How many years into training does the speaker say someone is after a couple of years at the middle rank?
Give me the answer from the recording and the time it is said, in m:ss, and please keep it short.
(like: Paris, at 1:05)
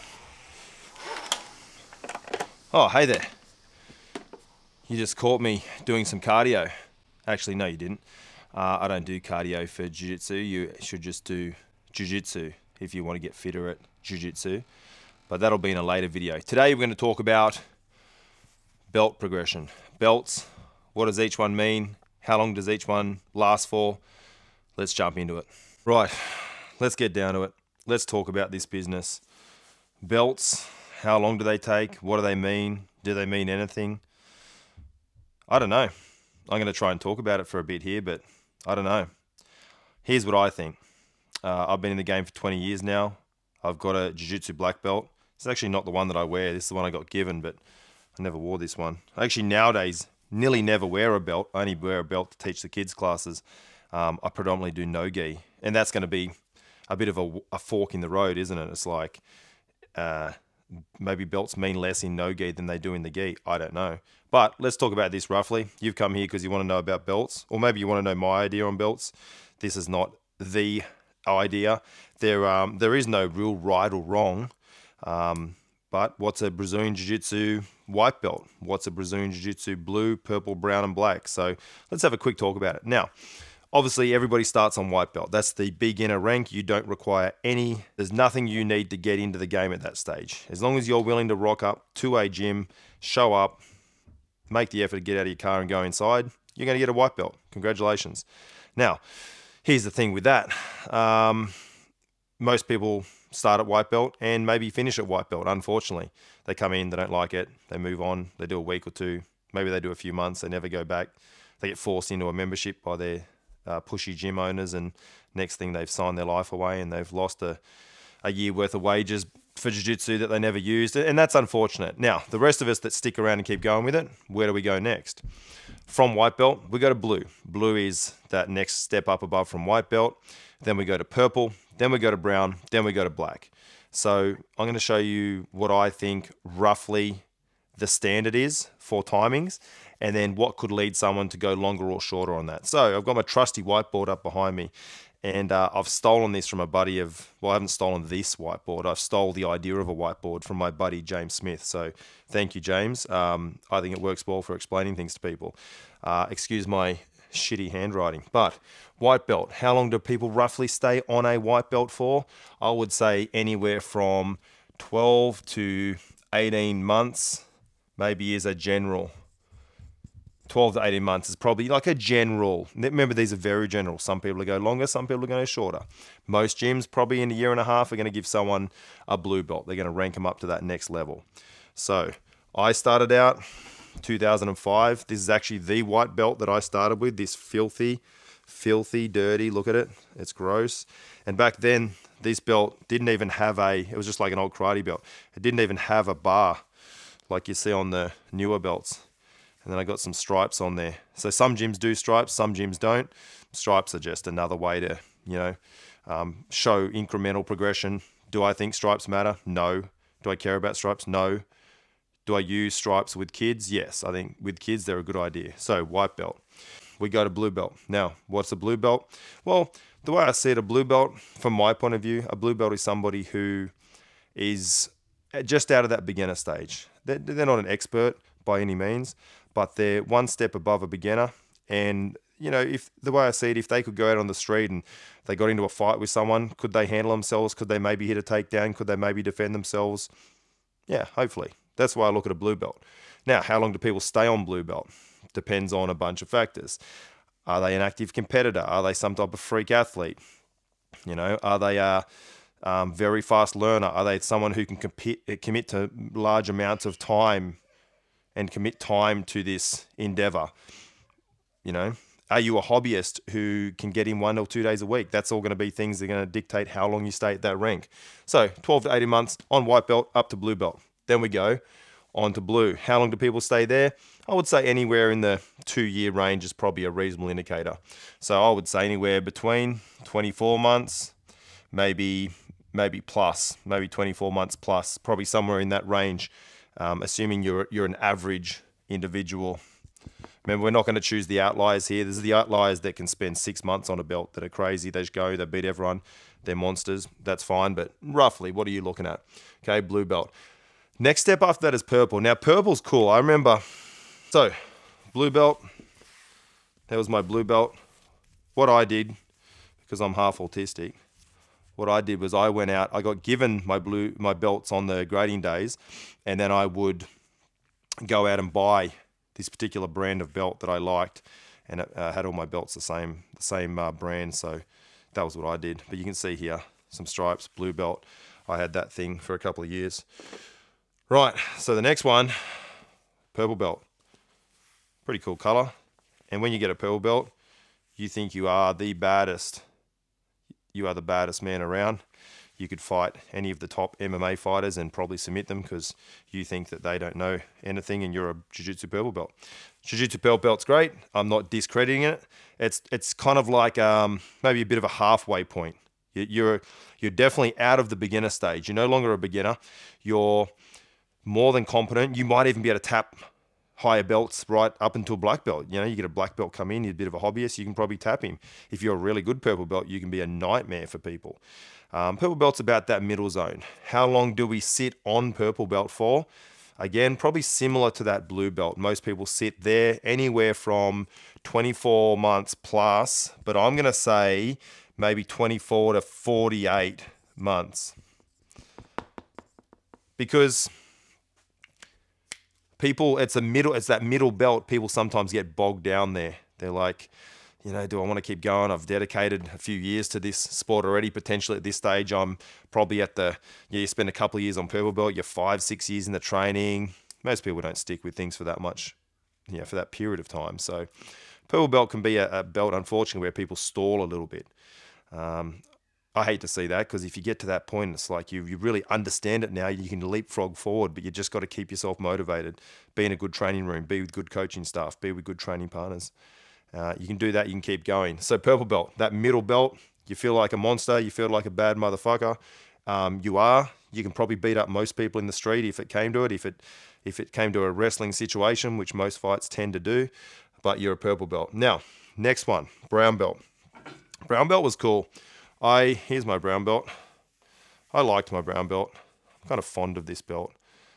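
5 or 6 years, at 6:45.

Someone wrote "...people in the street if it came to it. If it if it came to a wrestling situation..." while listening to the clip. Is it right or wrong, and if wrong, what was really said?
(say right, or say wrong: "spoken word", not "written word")
right.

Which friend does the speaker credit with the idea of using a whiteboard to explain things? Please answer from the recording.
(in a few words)
James Smith.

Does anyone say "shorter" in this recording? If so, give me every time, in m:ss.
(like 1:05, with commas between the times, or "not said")
2:22, 2:55.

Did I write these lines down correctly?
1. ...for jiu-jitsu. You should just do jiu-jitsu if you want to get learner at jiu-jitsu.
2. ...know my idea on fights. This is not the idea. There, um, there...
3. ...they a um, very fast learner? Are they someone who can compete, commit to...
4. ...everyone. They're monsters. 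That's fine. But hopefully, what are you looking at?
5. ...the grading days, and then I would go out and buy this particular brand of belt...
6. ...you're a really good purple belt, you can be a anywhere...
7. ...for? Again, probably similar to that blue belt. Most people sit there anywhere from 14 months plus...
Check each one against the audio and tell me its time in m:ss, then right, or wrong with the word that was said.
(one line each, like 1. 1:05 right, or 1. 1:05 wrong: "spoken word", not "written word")
1. 0:09 wrong: "fitter", not "learner"
2. 1:08 wrong: "belts", not "fights"
3. 4:11 right
4. 4:55 wrong: "roughly", not "hopefully"
5. 5:14 right
6. 6:08 wrong: "nightmare", not "anywhere"
7. 6:15 wrong: "24", not "14".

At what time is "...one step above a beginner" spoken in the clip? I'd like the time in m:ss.
3:50.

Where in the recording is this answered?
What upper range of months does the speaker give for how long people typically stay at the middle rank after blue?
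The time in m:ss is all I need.
6:26.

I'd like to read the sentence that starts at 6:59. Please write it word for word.
You can leapfrog forward, but you just got to keep yourself motivated.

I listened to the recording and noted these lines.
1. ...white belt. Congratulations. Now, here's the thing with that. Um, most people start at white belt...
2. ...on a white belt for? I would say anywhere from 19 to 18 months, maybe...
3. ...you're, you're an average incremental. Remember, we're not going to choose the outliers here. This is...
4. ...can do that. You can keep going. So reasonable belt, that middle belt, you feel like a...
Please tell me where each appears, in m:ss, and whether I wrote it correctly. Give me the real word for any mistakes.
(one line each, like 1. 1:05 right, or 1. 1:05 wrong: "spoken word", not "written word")
1. 1:36 right
2. 2:41 wrong: "12", not "19"
3. 4:47 wrong: "individual", not "incremental"
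4. 7:07 wrong: "purple", not "reasonable".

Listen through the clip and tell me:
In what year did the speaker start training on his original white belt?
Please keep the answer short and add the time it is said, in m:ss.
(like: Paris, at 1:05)
2005, at 3:04.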